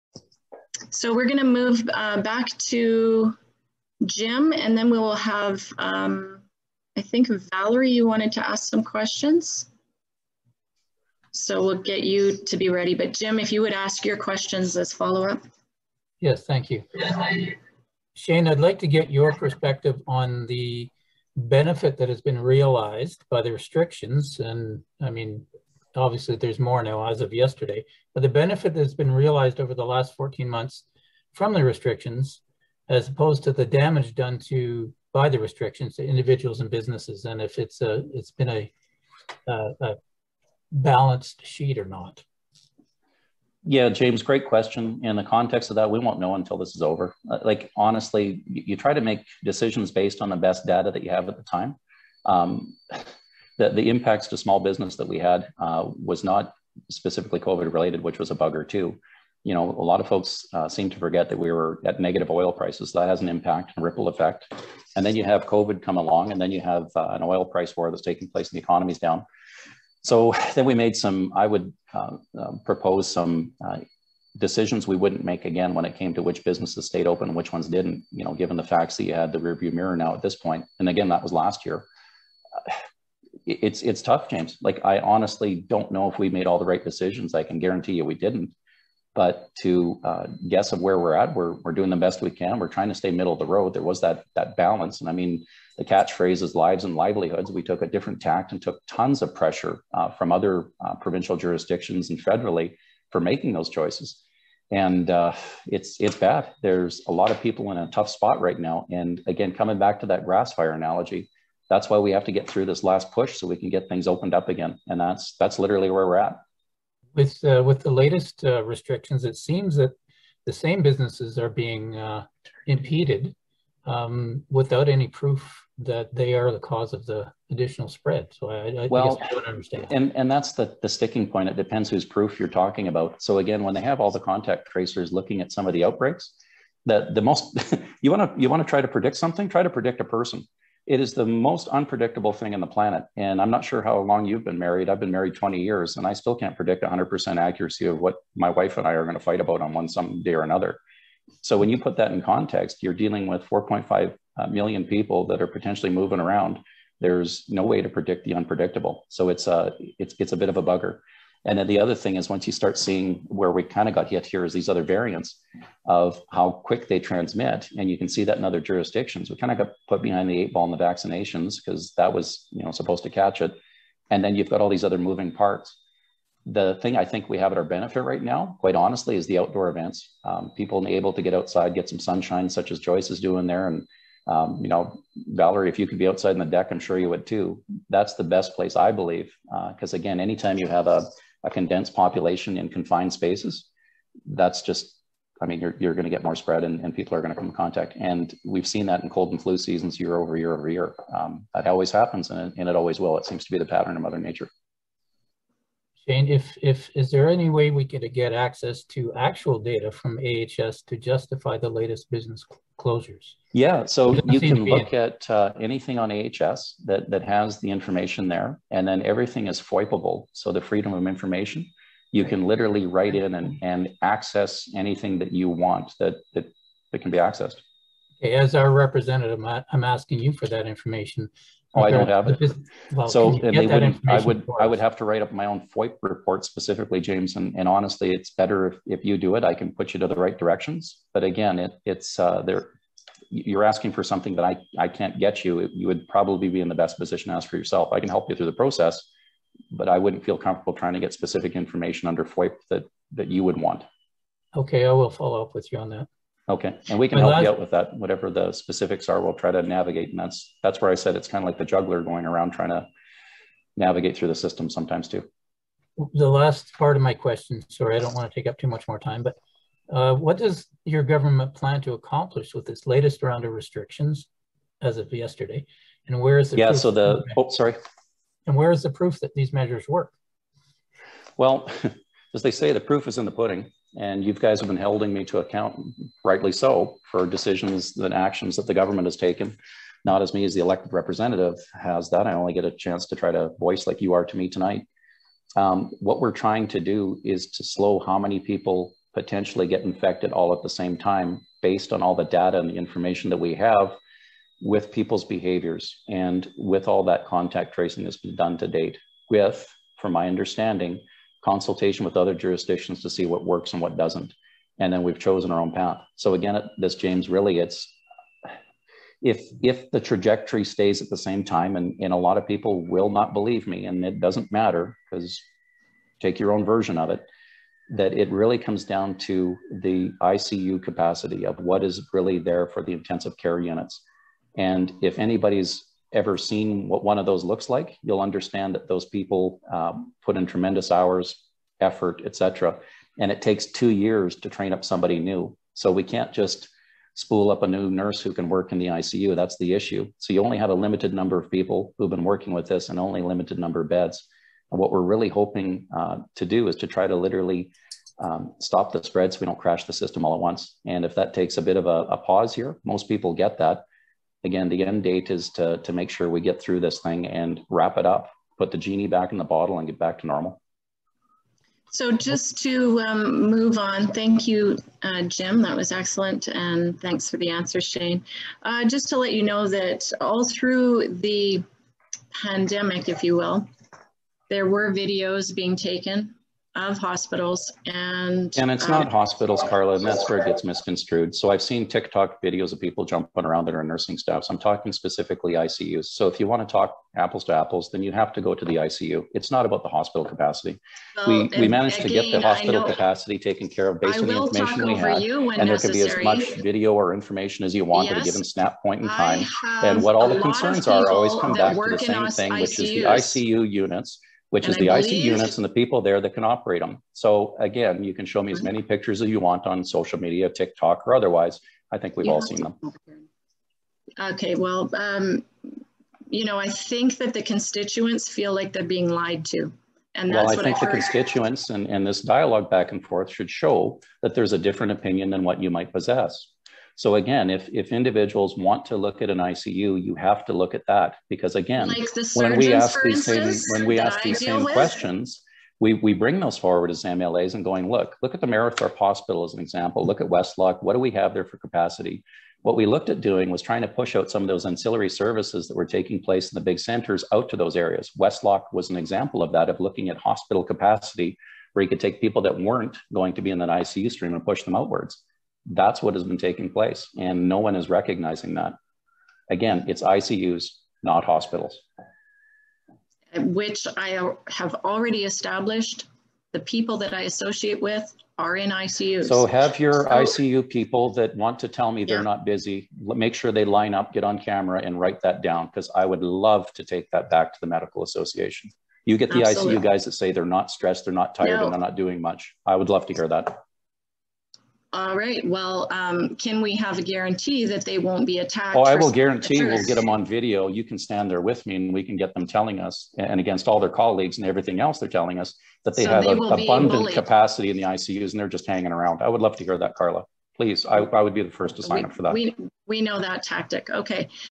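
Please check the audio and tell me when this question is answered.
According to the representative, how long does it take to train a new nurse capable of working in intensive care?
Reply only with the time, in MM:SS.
05:43.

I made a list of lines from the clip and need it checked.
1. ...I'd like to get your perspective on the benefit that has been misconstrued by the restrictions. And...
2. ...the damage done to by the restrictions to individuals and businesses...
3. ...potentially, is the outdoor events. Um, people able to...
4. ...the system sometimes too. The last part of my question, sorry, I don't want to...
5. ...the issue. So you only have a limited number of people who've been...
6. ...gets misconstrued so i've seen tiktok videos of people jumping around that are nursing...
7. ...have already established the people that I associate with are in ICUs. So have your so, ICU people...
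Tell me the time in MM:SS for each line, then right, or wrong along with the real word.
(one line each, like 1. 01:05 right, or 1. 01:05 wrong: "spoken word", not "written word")
1. 00:18 wrong: "realized", not "misconstrued"
2. 00:33 right
3. 02:58 wrong: "honestly", not "potentially"
4. 04:24 right
5. 05:49 right
6. 06:30 right
7. 07:54 right.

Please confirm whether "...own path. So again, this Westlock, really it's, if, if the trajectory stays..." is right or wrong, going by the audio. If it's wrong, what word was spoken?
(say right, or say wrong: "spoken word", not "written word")
wrong: "James", not "Westlock".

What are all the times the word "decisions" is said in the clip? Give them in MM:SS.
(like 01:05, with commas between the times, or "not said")
00:49, 01:14, 01:26, 04:47.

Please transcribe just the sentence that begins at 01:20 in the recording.
And again, that was last year it's it's tough, James.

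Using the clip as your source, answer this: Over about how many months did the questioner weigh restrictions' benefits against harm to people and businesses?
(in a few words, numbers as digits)
14.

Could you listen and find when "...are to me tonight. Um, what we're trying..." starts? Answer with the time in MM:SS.
04:54.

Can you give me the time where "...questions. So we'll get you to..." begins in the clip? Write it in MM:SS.
00:08.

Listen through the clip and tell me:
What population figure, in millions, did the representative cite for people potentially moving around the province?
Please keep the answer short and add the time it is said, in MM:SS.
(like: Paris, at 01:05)
4.5 million, at 02:33.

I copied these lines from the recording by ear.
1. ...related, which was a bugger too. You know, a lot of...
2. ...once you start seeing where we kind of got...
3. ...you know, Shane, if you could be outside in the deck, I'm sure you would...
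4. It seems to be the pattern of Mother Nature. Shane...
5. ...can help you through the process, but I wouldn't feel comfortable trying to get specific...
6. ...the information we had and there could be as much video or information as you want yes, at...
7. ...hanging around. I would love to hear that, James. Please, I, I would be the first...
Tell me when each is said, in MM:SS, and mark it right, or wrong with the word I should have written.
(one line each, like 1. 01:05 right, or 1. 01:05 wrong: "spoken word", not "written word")
1. 00:57 right
2. 02:42 right
3. 03:04 wrong: "Valerie", not "Shane"
4. 03:23 right
5. 04:08 right
6. 06:44 right
7. 08:28 wrong: "Carla", not "James".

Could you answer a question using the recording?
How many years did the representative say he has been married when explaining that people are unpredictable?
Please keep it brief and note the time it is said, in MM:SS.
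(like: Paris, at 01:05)
20, at 02:25.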